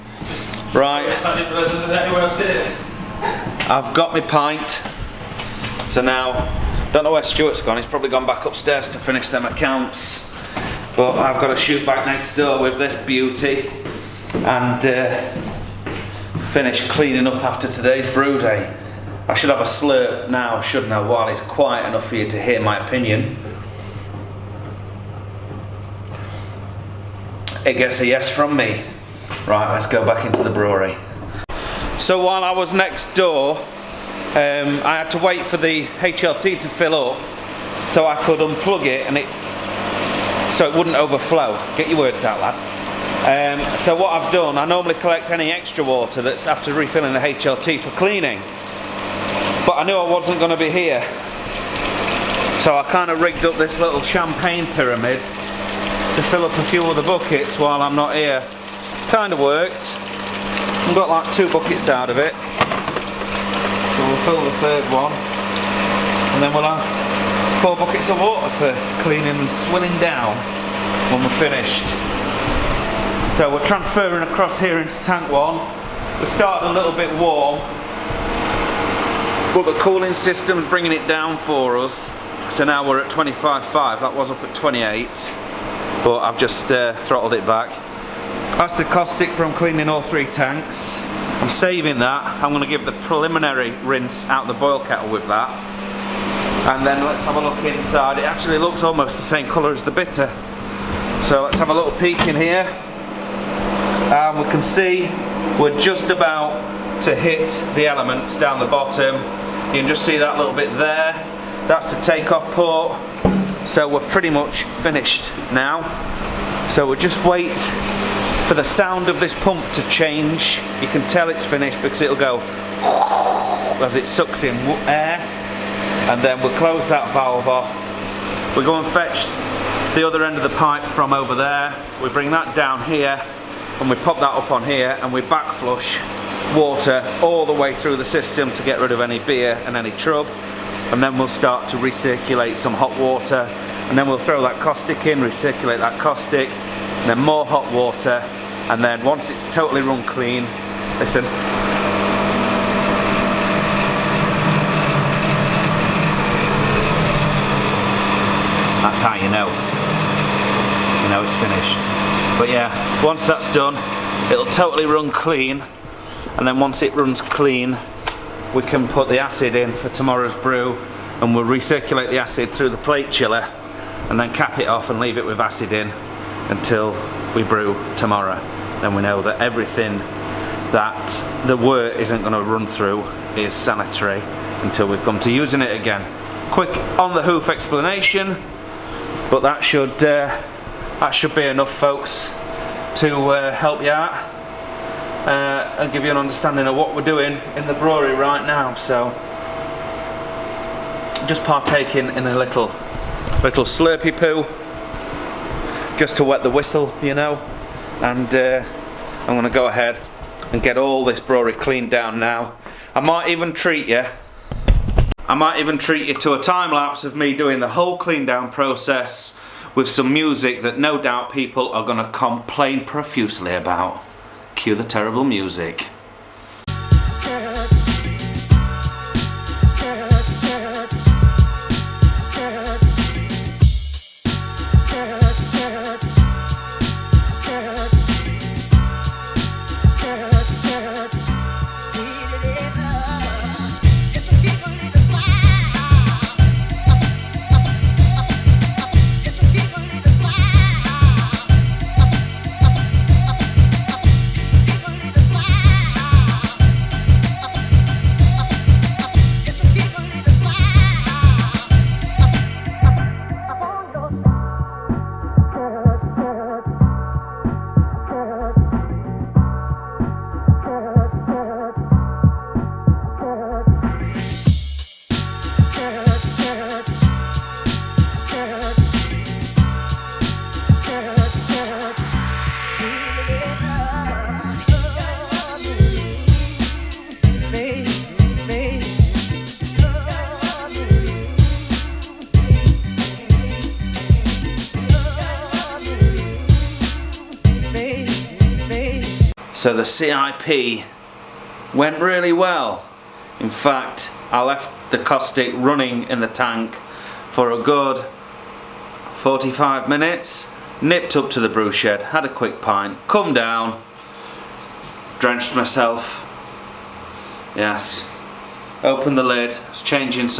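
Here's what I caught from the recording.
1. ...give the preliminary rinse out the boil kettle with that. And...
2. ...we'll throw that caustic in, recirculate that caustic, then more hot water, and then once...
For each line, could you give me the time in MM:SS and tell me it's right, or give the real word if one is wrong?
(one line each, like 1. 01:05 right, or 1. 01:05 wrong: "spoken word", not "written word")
1. 01:32 right
2. 02:24 right.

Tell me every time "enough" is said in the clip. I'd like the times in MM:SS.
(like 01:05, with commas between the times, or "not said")
00:21, 03:11.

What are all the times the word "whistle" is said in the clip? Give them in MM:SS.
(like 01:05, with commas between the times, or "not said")
03:26.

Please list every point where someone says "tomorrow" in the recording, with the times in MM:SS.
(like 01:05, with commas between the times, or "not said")
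02:49, 02:57.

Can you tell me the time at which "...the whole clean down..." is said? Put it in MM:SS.
03:37.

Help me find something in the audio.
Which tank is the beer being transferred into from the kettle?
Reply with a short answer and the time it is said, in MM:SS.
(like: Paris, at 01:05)
tank 1, at 01:14.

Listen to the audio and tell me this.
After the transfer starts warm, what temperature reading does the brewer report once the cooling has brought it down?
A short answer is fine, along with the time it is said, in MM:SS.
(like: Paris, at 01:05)
25.5, at 01:23.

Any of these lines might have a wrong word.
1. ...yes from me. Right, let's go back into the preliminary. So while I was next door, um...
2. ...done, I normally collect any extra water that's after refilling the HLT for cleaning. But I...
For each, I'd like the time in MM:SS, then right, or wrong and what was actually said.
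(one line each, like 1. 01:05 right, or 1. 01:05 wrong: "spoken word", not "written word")
1. 00:28 wrong: "brewery", not "preliminary"
2. 00:44 right.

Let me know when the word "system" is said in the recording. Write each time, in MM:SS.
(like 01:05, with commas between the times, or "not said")
01:20, 02:18.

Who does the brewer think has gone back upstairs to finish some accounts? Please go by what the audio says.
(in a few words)
Stuart.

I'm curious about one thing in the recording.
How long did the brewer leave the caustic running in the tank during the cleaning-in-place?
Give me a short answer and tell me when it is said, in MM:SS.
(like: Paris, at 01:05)
45 minutes, at 05:09.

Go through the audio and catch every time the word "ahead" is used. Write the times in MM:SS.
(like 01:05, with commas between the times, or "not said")
03:29.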